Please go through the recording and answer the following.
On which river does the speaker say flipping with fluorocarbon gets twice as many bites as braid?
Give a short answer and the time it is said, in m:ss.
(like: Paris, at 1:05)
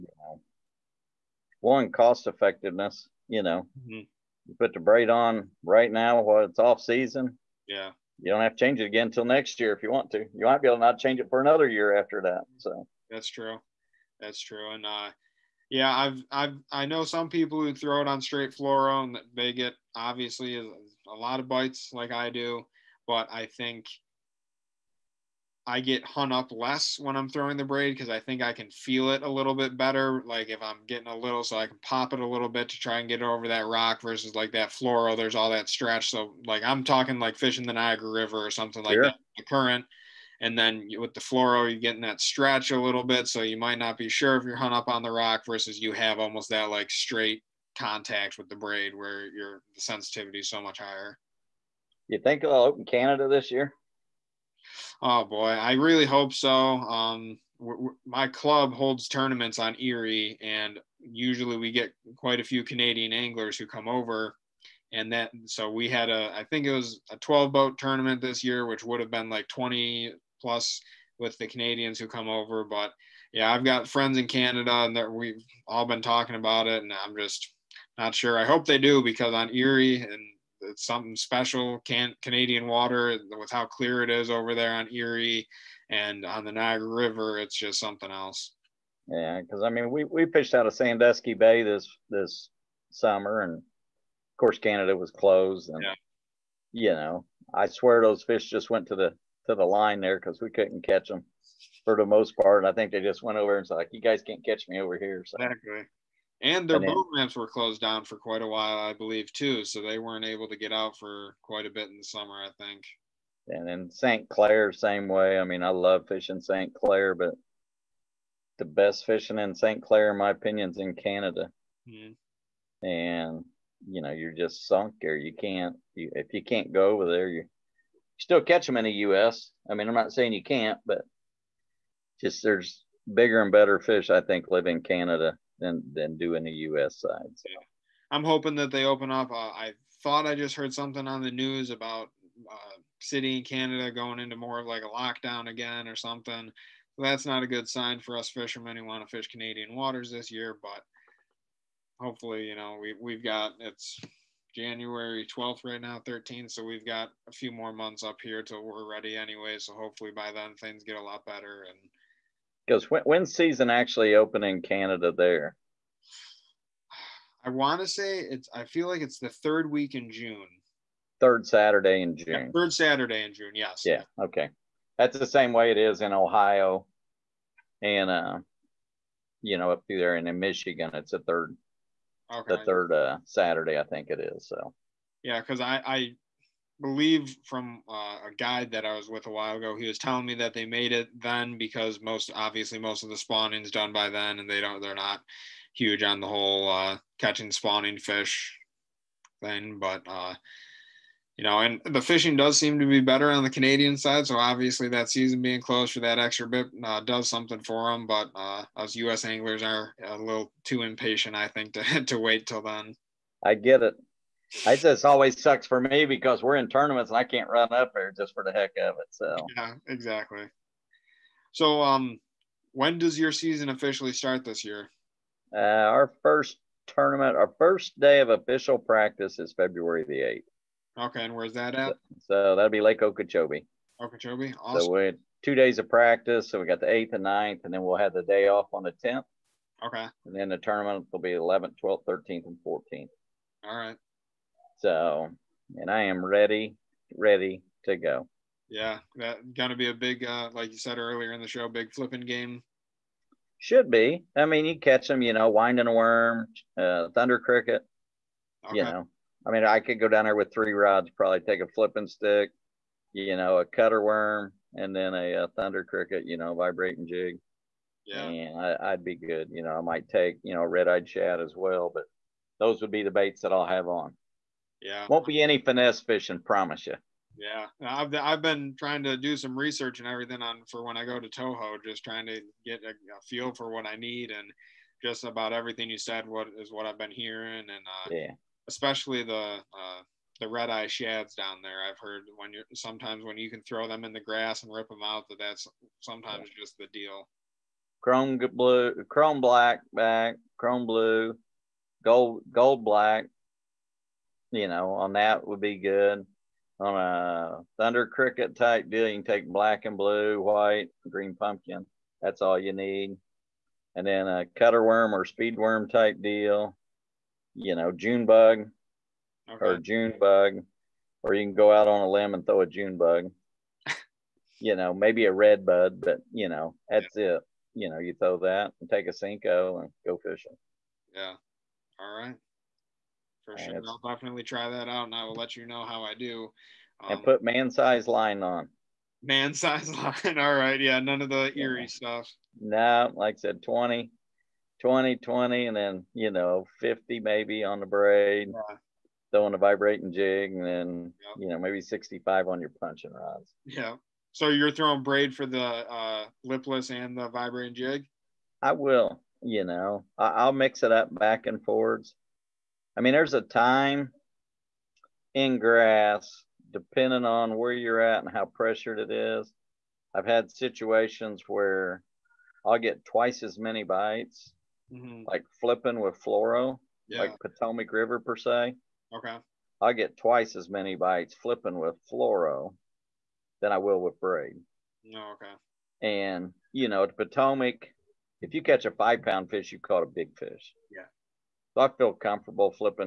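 Potomac River, at 6:17.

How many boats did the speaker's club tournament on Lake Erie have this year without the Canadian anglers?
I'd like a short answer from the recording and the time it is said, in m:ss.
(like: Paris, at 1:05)
12, at 1:07.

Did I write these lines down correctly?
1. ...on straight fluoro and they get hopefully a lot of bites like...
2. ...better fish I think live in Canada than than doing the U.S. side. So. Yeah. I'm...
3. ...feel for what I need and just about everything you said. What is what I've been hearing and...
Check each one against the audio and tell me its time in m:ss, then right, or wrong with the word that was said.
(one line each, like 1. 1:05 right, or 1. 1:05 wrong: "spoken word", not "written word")
1. 0:18 wrong: "obviously", not "hopefully"
2. 2:13 right
3. 4:43 right.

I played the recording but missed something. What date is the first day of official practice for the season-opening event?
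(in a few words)
February 8.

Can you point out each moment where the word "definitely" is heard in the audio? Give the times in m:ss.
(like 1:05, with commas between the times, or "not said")
5:34.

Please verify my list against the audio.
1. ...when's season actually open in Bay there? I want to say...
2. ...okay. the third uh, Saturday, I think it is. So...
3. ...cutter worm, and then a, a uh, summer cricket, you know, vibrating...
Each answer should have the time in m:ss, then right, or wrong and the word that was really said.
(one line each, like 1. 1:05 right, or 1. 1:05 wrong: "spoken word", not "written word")
1. 2:43 wrong: "Canada", not "Bay"
2. 3:02 right
3. 4:23 wrong: "thunder", not "summer".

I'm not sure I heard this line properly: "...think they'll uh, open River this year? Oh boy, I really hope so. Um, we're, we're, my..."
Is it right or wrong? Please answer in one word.
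wrong.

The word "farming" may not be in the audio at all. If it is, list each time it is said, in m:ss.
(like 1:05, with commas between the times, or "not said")
not said.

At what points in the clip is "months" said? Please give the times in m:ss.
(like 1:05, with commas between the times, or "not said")
2:37.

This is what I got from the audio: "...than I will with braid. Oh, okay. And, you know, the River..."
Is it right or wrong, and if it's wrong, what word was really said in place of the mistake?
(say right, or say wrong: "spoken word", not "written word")
wrong: "Potomac", not "River".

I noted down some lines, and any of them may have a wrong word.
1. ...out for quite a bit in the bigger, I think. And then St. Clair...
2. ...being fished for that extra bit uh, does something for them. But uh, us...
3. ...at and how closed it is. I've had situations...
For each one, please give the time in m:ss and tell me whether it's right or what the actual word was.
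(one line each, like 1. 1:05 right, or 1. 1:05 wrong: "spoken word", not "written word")
1. 1:50 wrong: "summer", not "bigger"
2. 3:25 wrong: "closed", not "fished"
3. 6:08 wrong: "pressured", not "closed".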